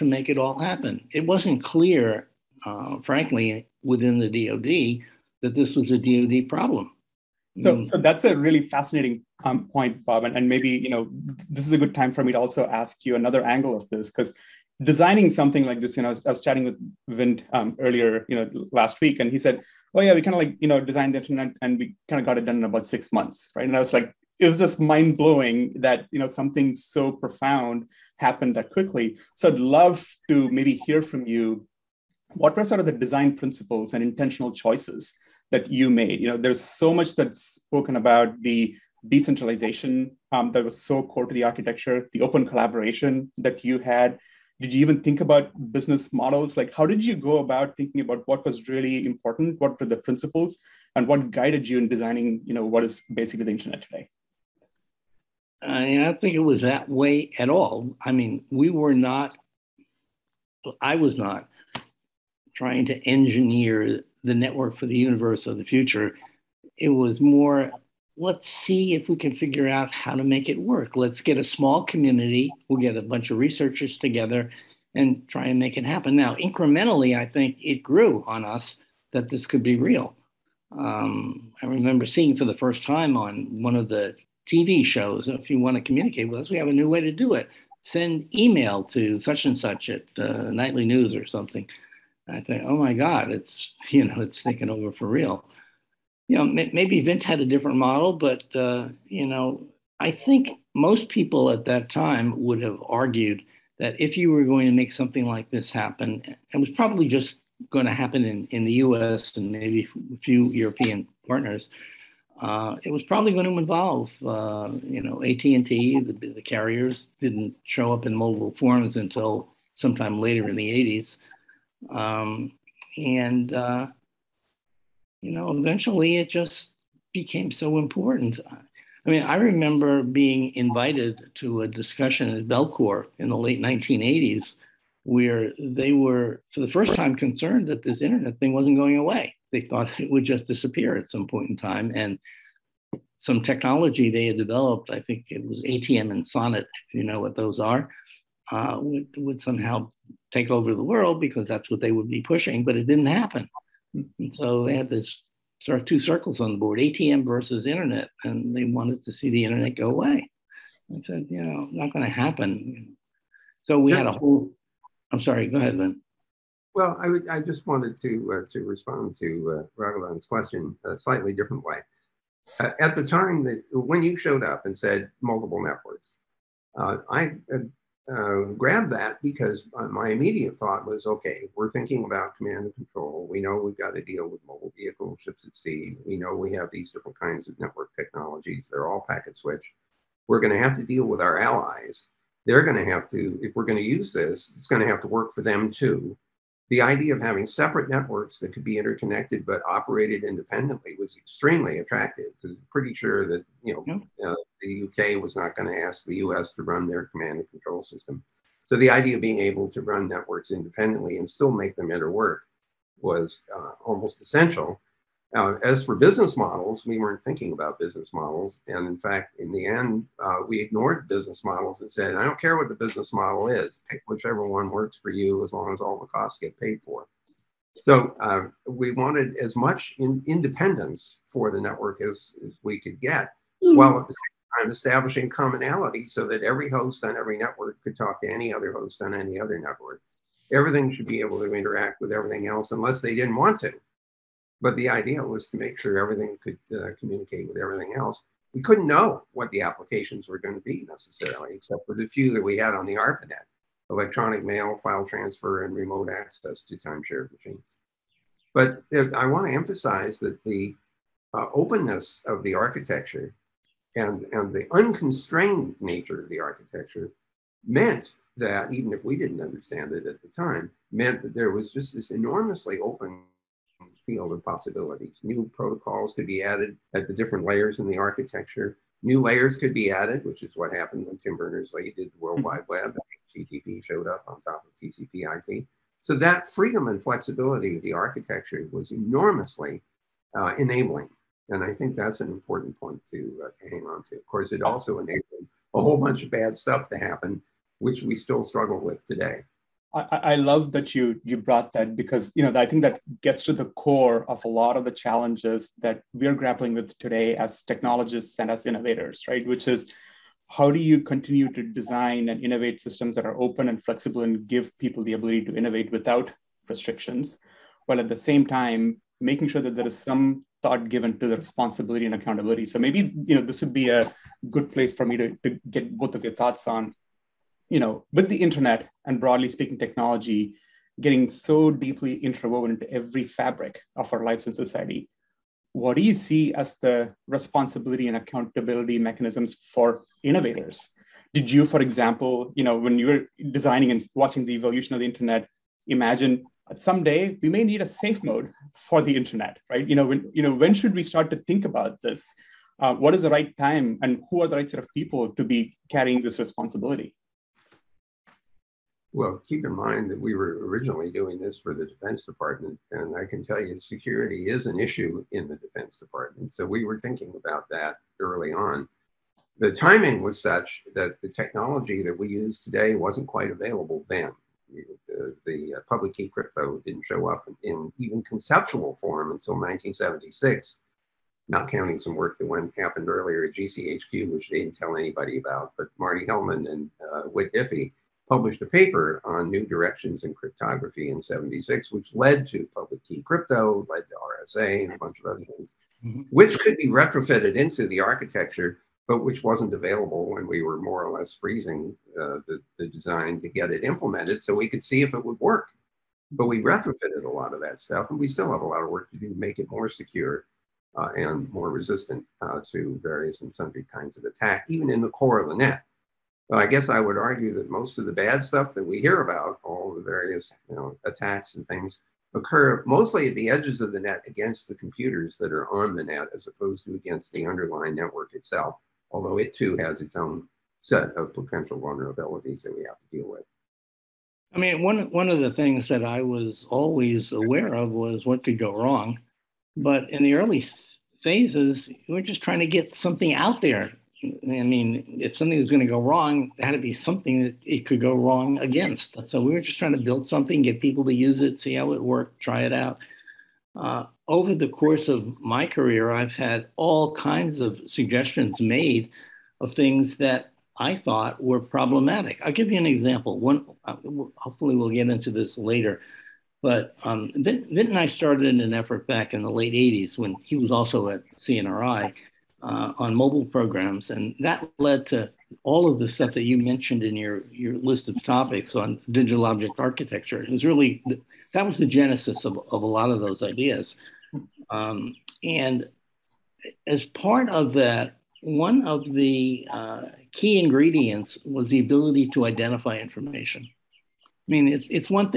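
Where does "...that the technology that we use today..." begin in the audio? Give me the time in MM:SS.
06:10.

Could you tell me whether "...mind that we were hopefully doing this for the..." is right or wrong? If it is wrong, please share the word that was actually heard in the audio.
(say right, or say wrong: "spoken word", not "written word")
wrong: "originally", not "hopefully".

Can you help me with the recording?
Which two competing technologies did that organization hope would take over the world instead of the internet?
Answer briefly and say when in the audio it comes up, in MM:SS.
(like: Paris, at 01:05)
ATM and SONET, at 02:25.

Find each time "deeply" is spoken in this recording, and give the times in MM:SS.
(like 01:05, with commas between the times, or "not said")
05:31.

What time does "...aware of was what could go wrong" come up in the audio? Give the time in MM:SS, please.
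07:17.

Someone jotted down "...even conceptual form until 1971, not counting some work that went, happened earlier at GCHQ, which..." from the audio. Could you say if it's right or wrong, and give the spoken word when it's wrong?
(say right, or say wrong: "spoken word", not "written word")
wrong: "1976", not "1971".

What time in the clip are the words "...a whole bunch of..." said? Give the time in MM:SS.
04:55.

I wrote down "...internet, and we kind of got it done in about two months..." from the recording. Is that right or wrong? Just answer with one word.
wrong.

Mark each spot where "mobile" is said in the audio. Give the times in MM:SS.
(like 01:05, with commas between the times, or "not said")
01:58, 03:04, 07:53.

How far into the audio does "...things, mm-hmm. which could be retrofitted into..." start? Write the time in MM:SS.
06:35.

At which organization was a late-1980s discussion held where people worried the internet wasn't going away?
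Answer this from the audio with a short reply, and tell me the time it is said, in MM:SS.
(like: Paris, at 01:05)
Bellcore, at 02:12.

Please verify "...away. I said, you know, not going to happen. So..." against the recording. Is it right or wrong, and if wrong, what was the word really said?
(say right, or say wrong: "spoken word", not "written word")
right.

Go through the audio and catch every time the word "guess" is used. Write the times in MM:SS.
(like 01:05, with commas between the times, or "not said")
06:56.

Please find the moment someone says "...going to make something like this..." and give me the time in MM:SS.
01:44.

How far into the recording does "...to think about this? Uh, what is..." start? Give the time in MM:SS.
05:51.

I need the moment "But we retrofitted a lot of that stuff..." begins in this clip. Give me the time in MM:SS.
06:46.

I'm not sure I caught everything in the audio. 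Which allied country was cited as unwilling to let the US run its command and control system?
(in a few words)
UK.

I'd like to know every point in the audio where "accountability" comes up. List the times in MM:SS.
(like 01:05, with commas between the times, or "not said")
05:22, 05:38.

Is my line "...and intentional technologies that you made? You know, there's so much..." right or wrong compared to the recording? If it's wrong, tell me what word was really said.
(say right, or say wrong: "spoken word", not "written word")
wrong: "choices", not "technologies".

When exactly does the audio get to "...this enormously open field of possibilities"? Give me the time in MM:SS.
04:31.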